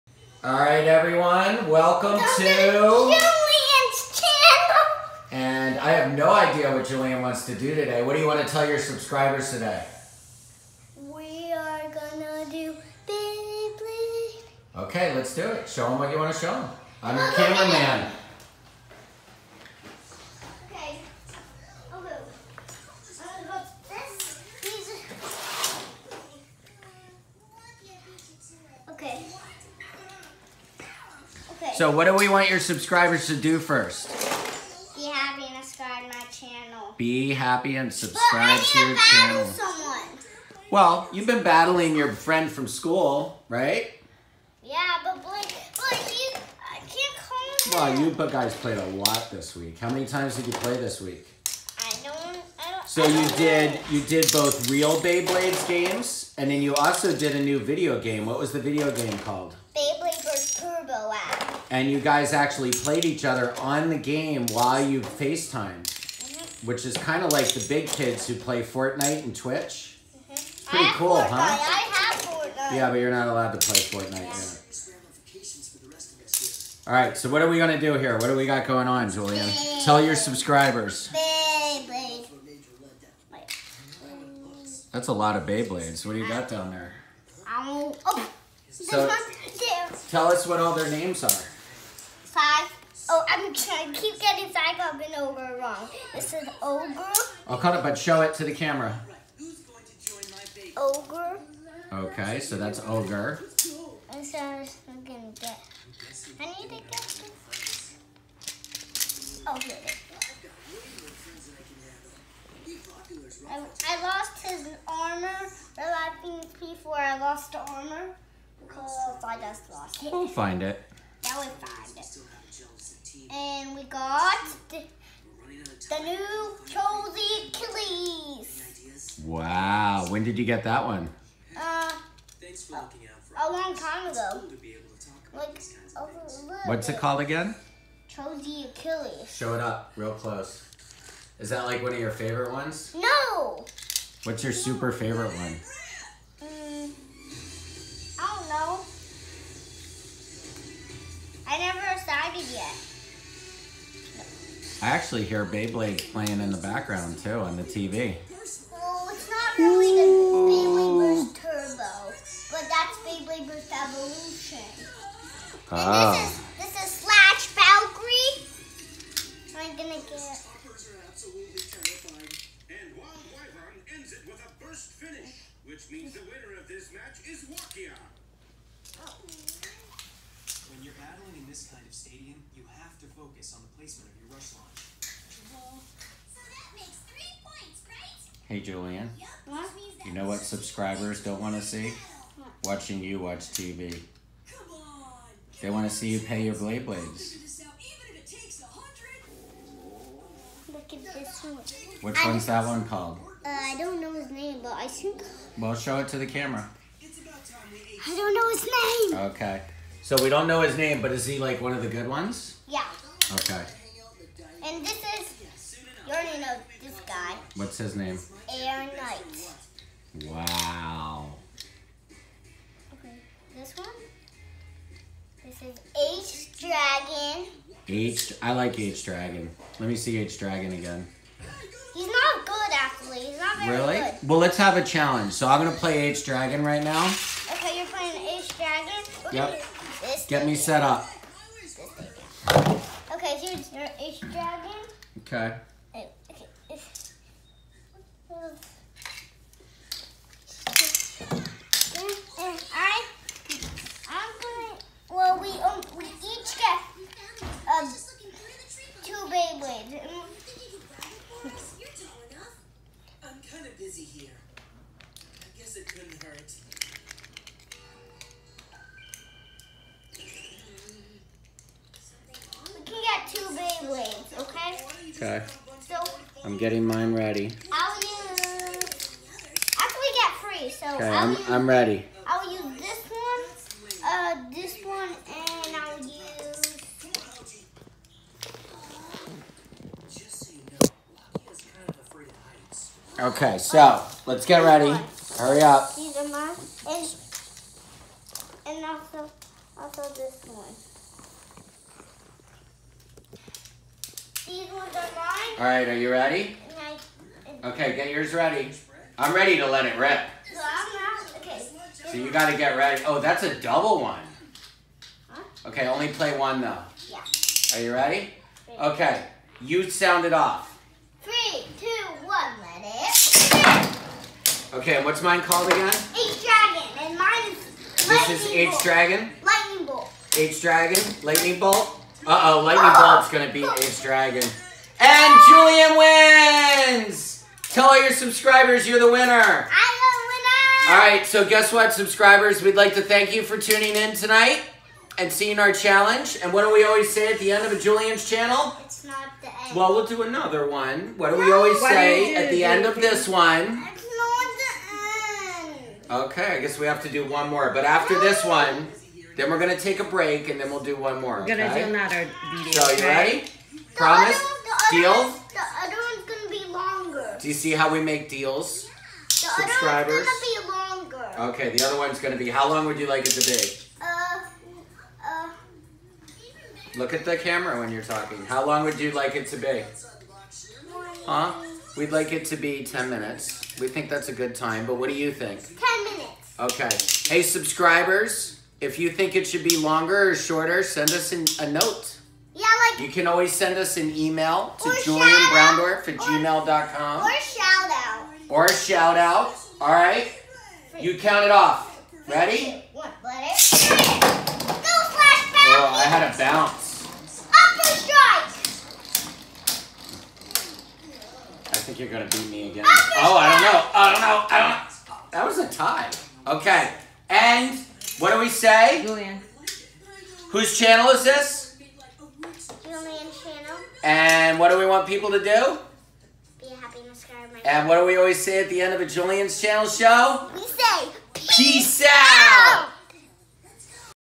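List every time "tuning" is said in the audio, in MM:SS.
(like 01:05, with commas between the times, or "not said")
05:43.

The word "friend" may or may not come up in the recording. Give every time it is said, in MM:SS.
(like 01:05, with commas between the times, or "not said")
00:42.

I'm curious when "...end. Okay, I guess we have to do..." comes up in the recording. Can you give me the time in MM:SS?
05:55.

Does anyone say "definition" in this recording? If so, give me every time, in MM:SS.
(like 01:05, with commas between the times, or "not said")
not said.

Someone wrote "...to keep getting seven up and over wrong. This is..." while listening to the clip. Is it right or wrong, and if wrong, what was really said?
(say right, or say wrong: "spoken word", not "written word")
wrong: "five", not "seven".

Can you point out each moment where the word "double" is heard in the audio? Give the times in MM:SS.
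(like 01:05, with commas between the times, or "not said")
05:13.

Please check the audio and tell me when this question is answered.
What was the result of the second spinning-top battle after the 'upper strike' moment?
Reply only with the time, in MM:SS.
06:55.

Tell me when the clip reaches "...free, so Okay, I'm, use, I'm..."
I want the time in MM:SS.
04:40.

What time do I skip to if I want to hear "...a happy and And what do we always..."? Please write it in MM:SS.
07:06.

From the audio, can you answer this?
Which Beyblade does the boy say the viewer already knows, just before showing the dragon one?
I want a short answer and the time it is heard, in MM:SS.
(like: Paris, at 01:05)
Aaron Knight, at 03:38.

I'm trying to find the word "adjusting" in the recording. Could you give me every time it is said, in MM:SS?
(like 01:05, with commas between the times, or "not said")
not said.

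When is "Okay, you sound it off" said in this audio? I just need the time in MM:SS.
05:18.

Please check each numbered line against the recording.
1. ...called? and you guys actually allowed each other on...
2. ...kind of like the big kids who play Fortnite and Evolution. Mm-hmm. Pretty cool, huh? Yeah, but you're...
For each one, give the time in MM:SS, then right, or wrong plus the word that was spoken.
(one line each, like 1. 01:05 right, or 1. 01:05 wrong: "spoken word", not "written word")
1. 00:59 wrong: "played", not "allowed"
2. 01:06 wrong: "Twitch", not "Evolution".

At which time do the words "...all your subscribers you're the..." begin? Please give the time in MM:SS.
05:37.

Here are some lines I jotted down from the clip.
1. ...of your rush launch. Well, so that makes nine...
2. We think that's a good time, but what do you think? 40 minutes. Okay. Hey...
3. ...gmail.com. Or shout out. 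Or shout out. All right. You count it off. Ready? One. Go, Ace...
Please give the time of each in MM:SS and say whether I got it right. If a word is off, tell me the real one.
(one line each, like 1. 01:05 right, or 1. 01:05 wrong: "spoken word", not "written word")
1. 03:04 wrong: "three", not "nine"
2. 06:23 wrong: "10", not "40"
3. 06:36 wrong: "Flash", not "Ace".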